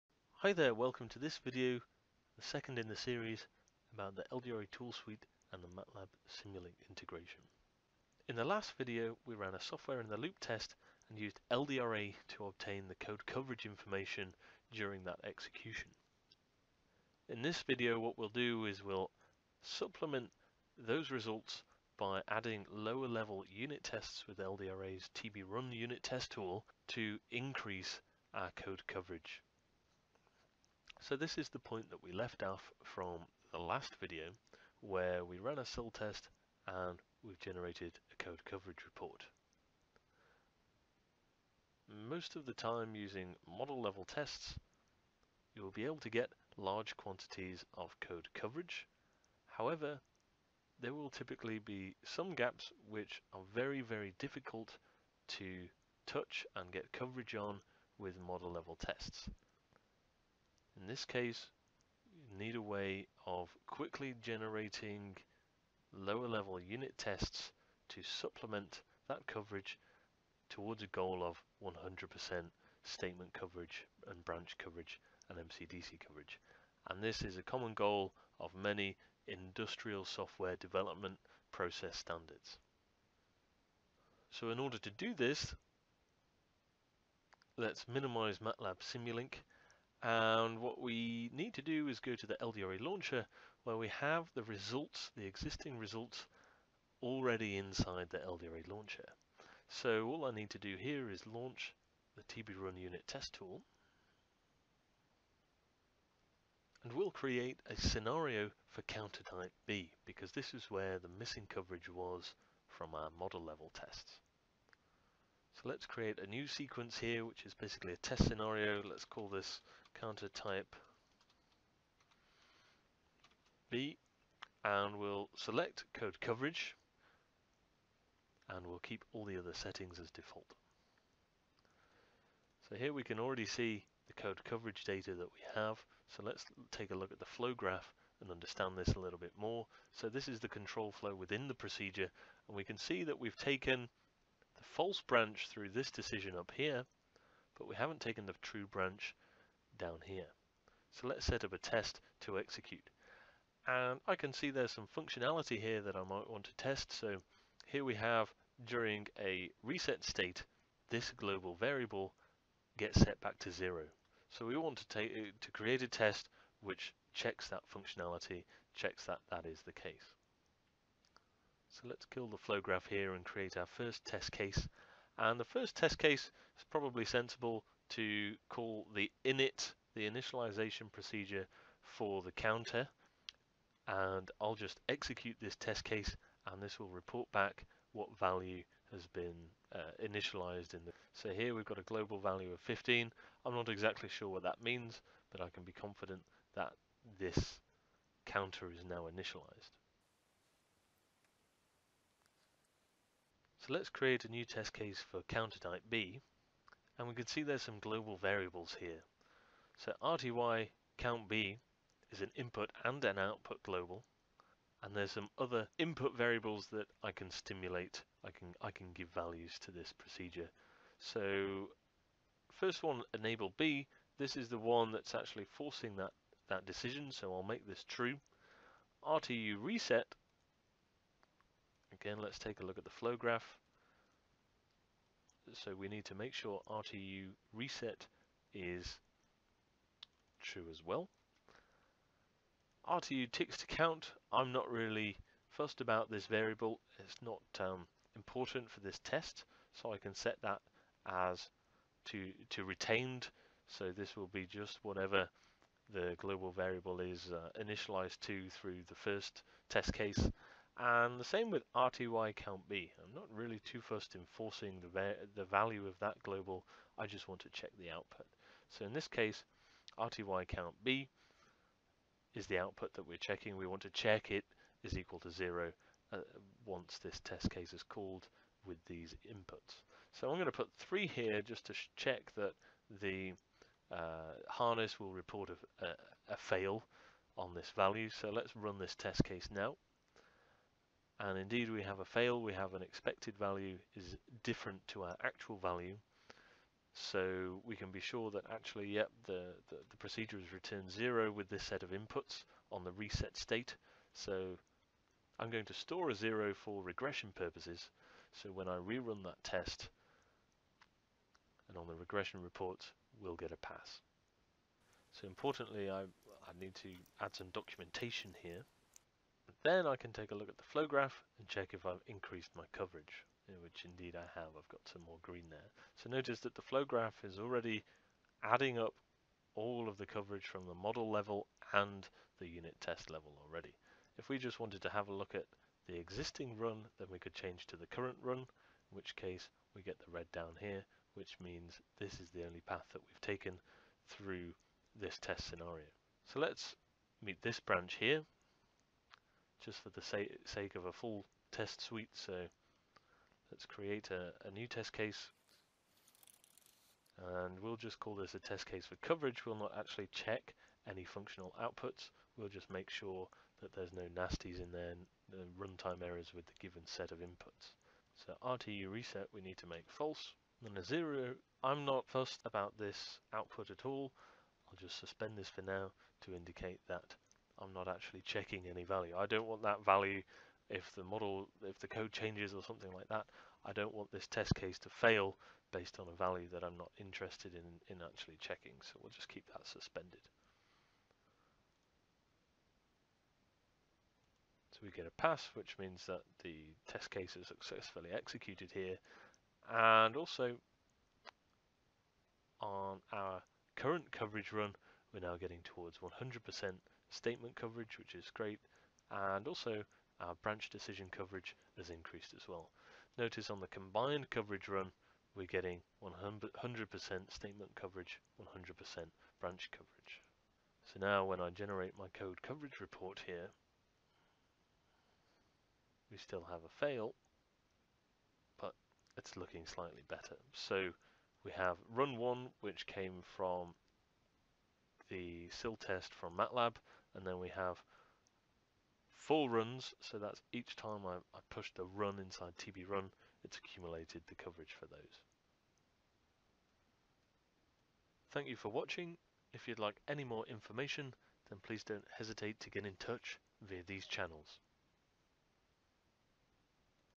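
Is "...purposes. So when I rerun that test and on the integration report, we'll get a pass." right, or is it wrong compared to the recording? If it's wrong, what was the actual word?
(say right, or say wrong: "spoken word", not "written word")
wrong: "regression", not "integration".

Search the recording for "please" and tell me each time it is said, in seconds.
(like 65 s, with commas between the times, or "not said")
451 s.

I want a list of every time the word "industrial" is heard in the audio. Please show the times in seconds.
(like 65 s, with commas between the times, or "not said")
79 s.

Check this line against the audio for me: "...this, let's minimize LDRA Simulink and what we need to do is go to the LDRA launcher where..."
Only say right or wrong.
wrong.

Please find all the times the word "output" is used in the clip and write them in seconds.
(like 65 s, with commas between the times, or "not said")
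213 s, 267 s, 272 s, 361 s, 373 s.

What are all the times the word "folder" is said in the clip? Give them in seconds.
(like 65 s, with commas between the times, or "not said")
not said.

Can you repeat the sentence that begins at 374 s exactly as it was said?
I'll just suspend this for now to indicate that I'm not actually checking any value.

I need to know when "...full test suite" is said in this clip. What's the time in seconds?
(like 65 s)
350 s.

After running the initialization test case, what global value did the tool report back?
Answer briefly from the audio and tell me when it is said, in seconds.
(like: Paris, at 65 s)
15, at 192 s.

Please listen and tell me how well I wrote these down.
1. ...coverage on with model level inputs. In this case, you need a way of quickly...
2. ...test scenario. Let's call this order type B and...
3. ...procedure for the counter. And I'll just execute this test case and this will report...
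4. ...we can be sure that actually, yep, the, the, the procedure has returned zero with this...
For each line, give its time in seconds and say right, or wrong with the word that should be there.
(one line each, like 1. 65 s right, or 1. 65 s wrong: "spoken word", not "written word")
1. 56 s wrong: "tests", not "inputs"
2. 117 s wrong: "counter", not "order"
3. 180 s right
4. 297 s right.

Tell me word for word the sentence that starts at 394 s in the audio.
So we get a pass, which means that the test case is successfully executed here.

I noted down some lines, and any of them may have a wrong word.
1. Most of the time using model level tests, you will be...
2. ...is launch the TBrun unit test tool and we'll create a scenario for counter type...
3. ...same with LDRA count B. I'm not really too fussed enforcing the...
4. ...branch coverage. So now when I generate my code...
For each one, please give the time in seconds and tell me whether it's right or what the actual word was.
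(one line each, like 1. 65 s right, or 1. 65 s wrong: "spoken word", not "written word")
1. 41 s right
2. 101 s right
3. 261 s wrong: "RTY", not "LDRA"
4. 419 s right.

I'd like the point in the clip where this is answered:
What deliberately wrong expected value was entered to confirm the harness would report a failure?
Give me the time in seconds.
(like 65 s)
280 s.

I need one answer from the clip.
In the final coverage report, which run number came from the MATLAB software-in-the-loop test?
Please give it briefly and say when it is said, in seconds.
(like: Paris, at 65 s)
1, at 431 s.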